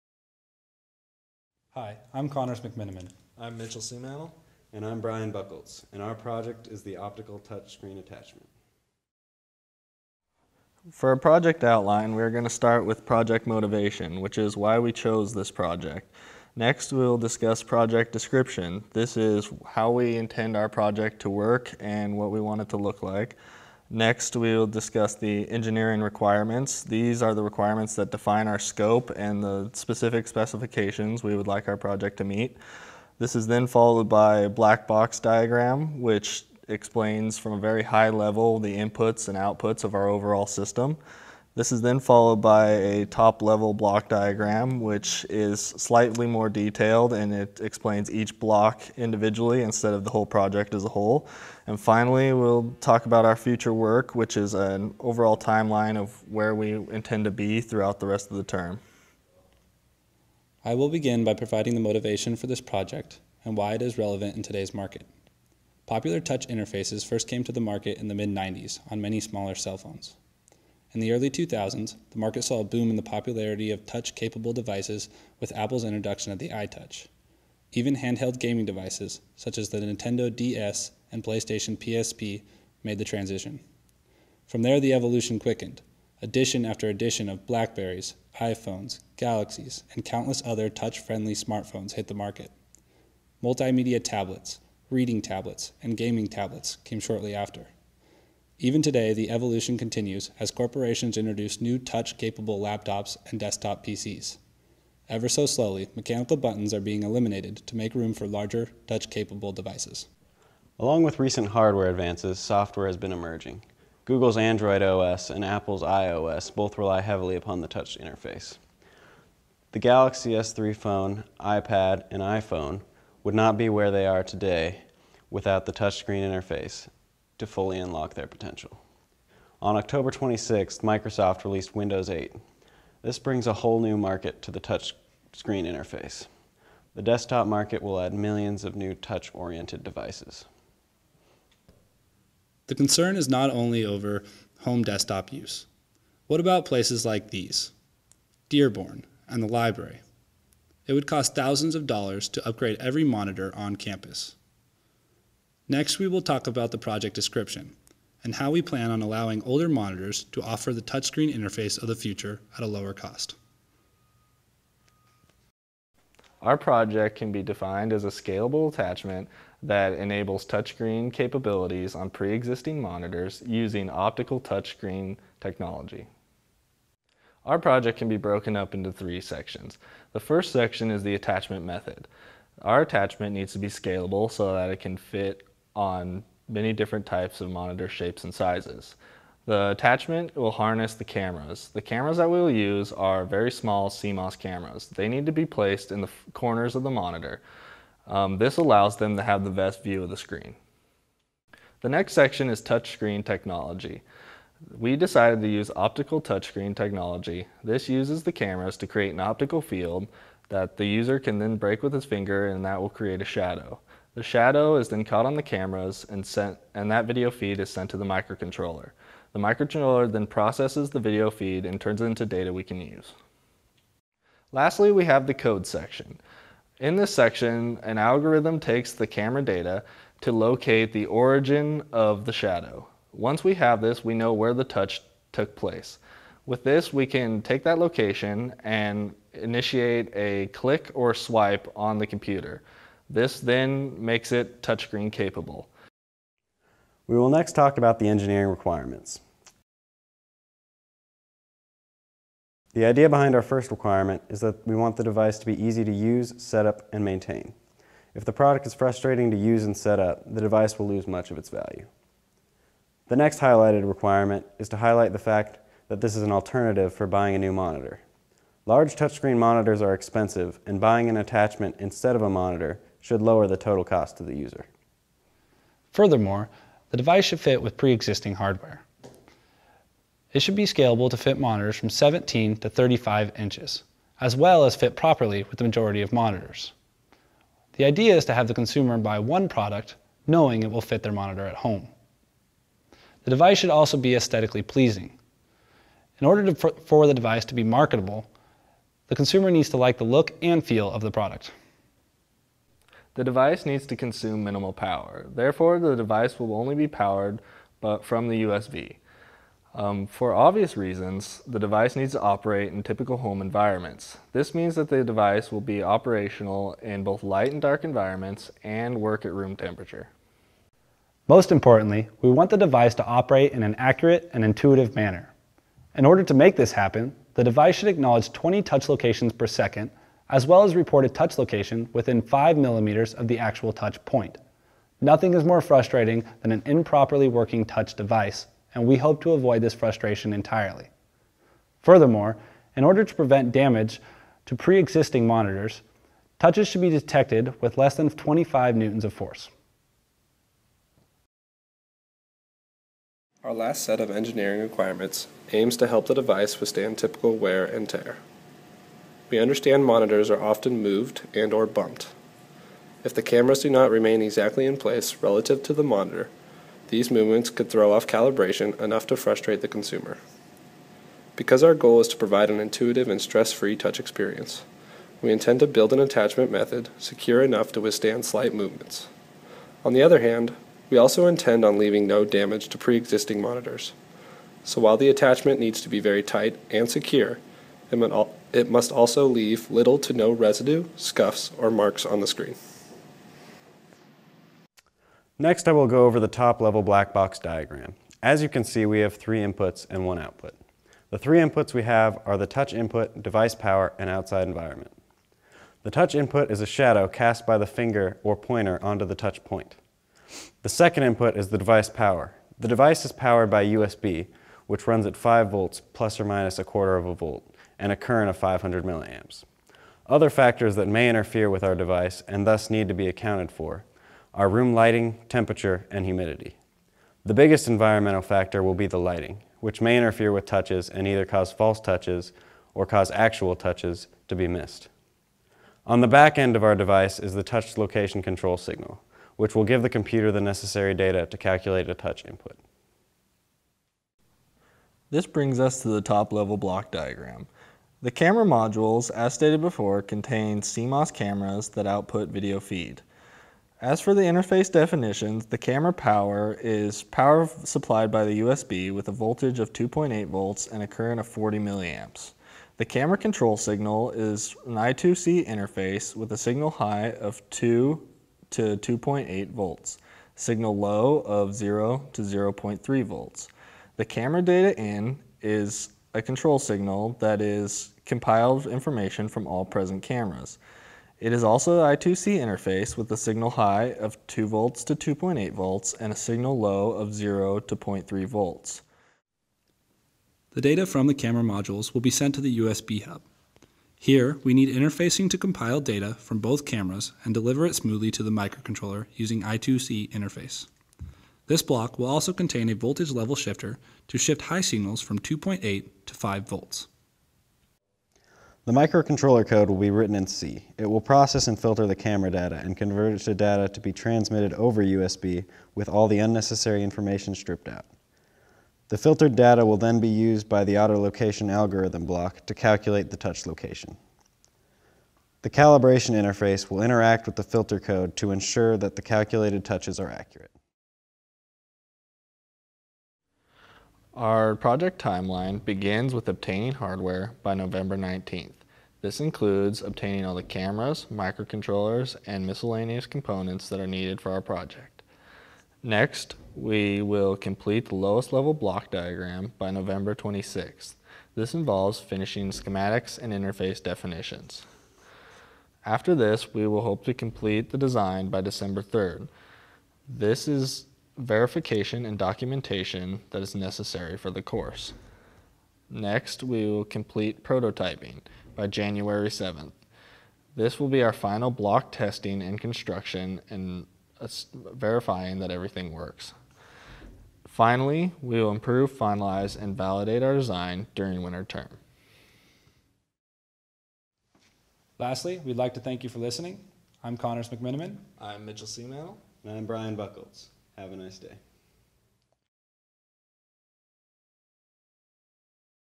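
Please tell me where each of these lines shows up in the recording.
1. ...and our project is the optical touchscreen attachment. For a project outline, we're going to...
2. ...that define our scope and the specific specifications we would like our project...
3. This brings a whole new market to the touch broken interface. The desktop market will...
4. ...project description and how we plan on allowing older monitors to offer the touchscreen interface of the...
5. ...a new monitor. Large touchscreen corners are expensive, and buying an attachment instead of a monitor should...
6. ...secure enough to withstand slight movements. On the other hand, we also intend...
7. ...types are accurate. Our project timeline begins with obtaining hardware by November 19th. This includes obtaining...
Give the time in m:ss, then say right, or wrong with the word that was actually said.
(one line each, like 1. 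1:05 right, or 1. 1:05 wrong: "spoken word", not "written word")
1. 0:05 right
2. 0:27 right
3. 2:13 wrong: "screen", not "broken"
4. 2:36 right
5. 4:27 wrong: "monitors", not "corners"
6. 6:16 right
7. 8:49 wrong: "touches", not "types".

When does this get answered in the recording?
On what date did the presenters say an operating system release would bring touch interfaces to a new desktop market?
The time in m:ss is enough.
2:09.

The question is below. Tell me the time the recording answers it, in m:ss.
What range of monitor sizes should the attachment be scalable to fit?
4:41.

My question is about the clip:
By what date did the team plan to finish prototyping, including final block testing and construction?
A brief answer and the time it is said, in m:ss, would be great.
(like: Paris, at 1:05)
January 7th, at 9:28.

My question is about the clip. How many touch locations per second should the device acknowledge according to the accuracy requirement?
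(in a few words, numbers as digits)
20.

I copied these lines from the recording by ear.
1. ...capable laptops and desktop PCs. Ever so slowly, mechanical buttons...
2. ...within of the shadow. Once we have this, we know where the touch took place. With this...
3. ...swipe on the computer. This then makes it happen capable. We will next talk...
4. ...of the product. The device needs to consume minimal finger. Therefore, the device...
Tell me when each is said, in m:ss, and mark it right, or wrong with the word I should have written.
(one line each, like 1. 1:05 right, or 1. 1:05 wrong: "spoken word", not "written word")
1. 1:42 right
2. 3:51 wrong: "origin", not "within"
3. 4:01 wrong: "touchscreen", not "happen"
4. 5:00 wrong: "power", not "finger".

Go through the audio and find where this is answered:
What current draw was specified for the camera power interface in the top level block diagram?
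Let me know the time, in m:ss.
7:41.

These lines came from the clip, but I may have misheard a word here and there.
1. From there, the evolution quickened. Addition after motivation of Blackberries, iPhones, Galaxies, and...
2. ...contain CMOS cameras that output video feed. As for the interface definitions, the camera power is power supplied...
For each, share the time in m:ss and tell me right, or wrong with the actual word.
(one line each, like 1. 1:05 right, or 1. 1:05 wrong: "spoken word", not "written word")
1. 1:24 wrong: "addition", not "motivation"
2. 7:30 right.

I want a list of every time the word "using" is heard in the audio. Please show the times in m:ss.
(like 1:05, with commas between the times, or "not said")
2:53, 8:19.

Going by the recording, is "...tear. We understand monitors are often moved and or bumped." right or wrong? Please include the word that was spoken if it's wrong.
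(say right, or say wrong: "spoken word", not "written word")
right.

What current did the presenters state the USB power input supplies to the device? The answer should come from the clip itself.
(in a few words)
500 milliamps.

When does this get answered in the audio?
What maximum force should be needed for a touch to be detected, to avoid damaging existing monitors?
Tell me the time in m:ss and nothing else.
5:48.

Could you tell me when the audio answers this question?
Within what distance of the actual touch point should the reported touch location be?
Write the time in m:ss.
5:32.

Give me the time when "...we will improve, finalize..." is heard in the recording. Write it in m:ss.
9:38.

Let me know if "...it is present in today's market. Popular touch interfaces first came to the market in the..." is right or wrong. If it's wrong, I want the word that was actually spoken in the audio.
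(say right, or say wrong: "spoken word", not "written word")
wrong: "relevant", not "present".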